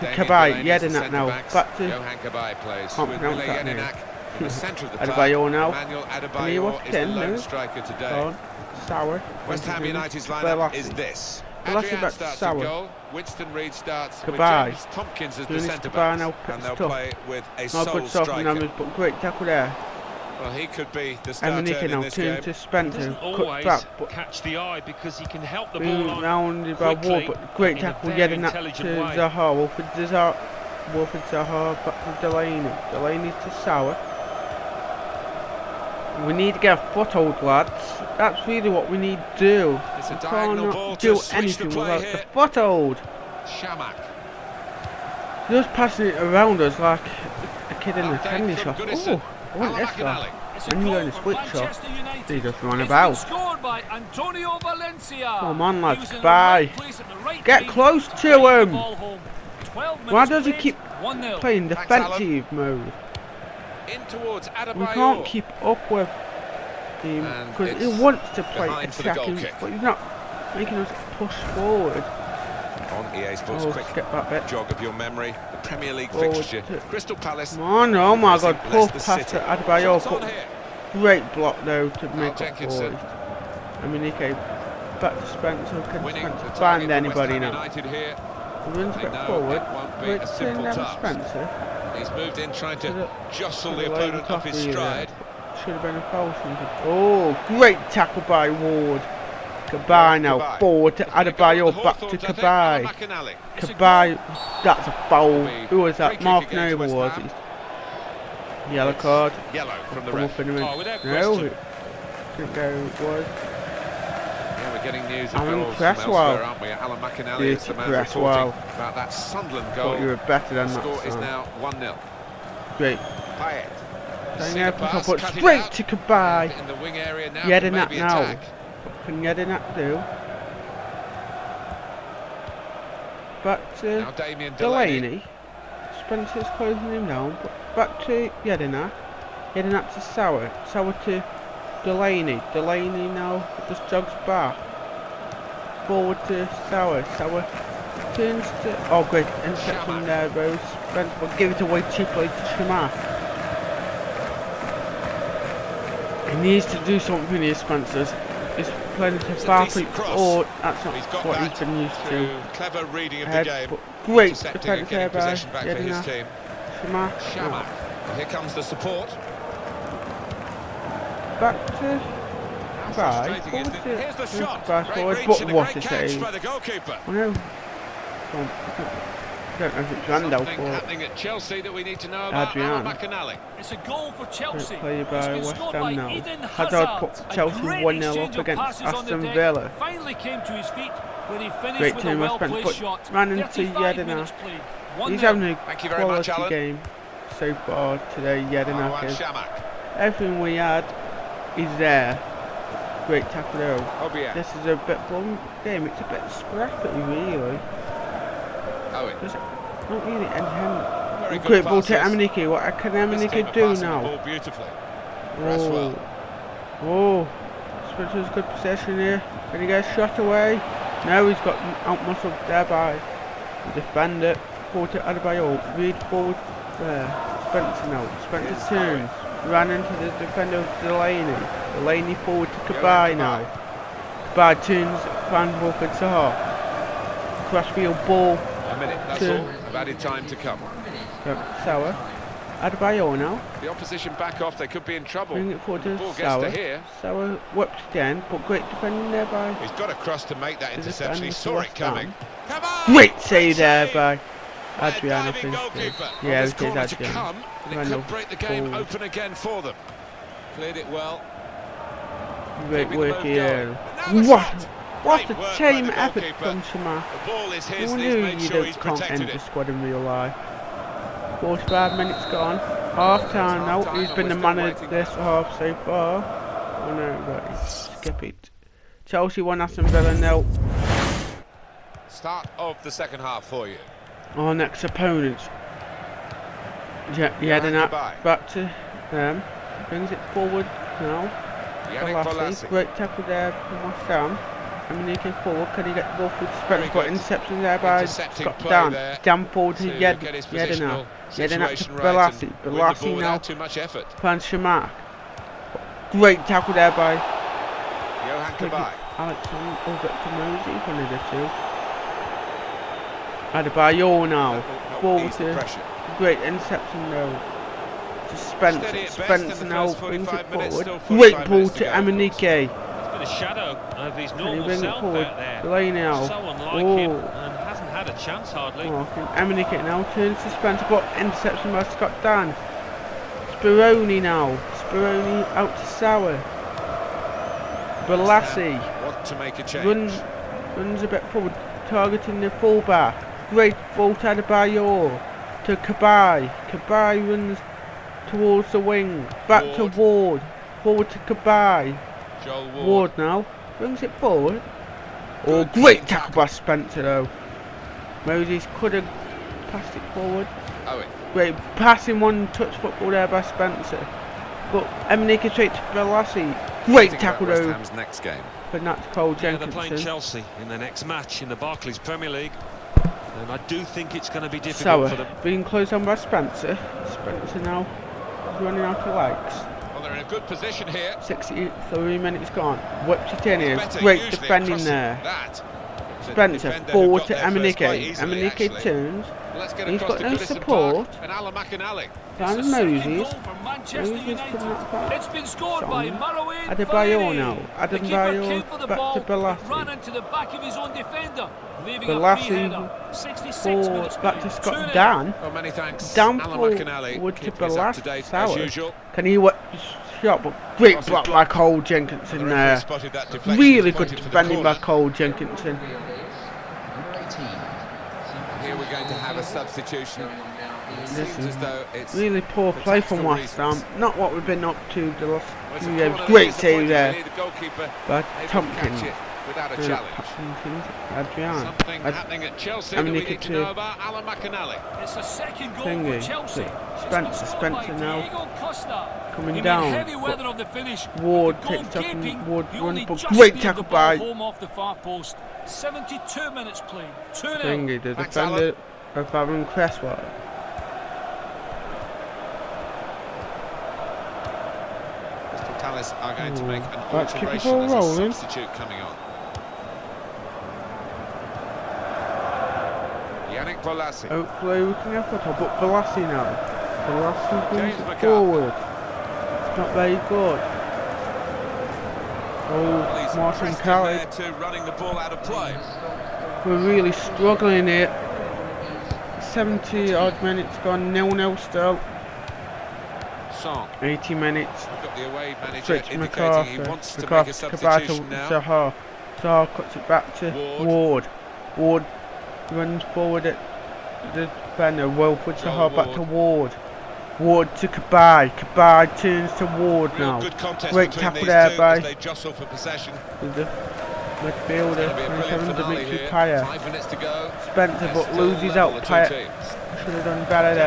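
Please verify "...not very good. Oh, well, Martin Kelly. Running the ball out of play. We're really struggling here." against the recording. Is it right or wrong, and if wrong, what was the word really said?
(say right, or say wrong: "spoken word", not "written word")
right.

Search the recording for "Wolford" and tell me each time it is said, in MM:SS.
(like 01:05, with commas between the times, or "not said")
03:55.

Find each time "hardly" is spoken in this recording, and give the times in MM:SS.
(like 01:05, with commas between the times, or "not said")
05:28.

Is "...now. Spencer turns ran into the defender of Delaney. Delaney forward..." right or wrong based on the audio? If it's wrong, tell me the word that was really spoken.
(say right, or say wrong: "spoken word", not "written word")
right.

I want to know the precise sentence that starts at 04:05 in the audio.
Bring it forward to ball Sour.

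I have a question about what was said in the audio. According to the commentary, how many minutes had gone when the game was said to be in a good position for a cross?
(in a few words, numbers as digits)
63.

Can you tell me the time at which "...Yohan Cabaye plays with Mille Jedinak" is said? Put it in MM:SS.
00:01.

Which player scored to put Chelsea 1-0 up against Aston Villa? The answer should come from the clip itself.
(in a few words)
Hazard.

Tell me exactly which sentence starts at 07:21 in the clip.
Ward takes up and Ward runs, but great tackle by.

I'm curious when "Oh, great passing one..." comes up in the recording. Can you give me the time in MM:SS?
06:01.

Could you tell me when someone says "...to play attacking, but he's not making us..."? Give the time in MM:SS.
01:08.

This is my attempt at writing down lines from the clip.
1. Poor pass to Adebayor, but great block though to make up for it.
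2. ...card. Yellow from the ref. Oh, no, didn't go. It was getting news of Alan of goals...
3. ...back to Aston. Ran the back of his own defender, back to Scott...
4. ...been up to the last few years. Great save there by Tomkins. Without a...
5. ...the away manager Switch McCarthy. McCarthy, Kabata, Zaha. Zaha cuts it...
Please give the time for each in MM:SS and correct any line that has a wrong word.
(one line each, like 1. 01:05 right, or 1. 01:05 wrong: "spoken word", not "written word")
1. 01:18 right
2. 01:48 right
3. 06:38 wrong: "Bolasie", not "Aston"
4. 07:04 right
5. 08:05 right.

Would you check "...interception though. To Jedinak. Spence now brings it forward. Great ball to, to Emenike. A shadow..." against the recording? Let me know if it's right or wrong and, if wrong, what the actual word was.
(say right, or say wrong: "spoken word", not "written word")
wrong: "Spence", not "Jedinak".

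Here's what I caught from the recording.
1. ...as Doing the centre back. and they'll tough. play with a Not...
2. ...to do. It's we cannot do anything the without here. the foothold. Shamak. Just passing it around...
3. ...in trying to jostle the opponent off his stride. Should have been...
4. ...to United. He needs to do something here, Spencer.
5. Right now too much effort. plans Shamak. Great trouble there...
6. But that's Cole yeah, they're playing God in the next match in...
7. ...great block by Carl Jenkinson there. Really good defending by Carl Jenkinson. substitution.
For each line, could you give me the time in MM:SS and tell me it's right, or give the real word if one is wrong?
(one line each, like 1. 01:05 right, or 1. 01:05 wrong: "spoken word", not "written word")
1. 00:15 right
2. 00:39 right
3. 01:32 right
4. 02:32 wrong: "Shamar", not "United"
5. 05:02 wrong: "tackle", not "trouble"
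6. 06:08 wrong: "Chelsea", not "God"
7. 06:50 right.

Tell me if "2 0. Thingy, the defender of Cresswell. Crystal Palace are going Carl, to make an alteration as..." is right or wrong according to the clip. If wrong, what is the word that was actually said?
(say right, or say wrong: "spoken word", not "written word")
wrong: "Ooh", not "Carl".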